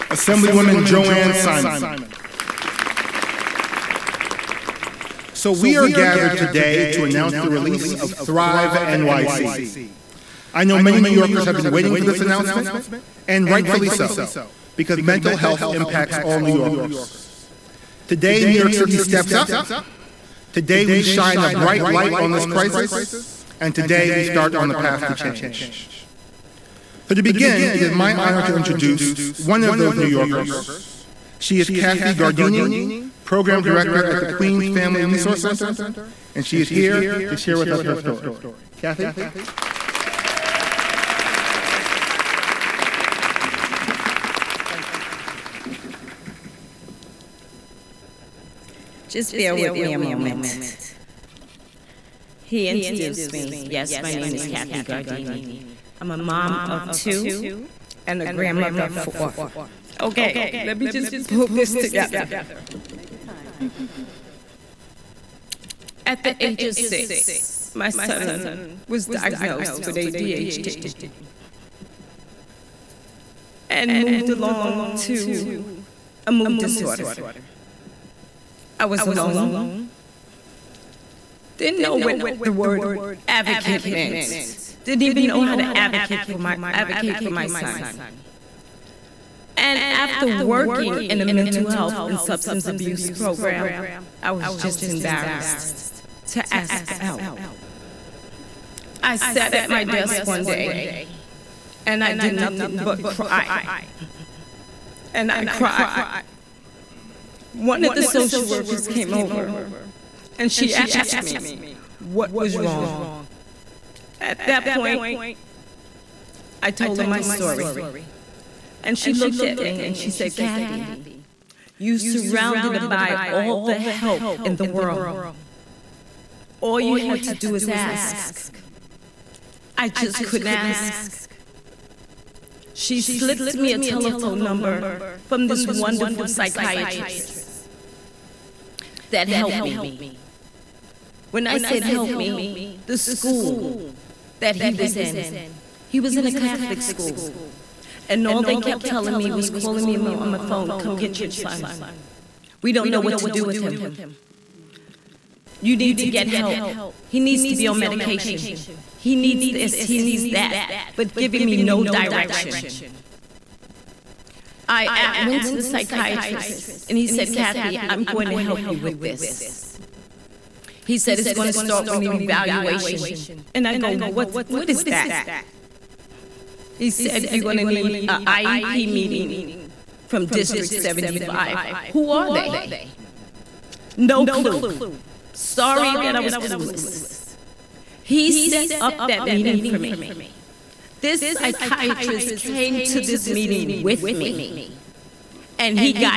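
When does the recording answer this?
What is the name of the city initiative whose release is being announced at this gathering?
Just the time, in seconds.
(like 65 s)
8 s.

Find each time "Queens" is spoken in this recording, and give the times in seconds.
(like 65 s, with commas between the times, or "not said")
34 s.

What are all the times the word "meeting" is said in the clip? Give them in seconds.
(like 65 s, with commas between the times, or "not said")
178 s, 189 s, 193 s.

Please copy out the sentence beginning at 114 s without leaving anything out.
At that point, I told her my story.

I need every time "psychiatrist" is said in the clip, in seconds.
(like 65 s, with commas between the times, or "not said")
136 s, 165 s, 191 s.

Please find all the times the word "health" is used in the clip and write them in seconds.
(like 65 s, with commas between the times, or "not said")
15 s, 91 s.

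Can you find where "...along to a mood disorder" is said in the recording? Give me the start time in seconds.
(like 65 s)
74 s.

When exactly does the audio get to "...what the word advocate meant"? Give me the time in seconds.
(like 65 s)
81 s.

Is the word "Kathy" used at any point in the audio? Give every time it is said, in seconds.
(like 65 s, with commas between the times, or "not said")
31 s, 38 s, 54 s, 120 s, 167 s.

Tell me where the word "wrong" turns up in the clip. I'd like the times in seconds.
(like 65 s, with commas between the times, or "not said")
112 s.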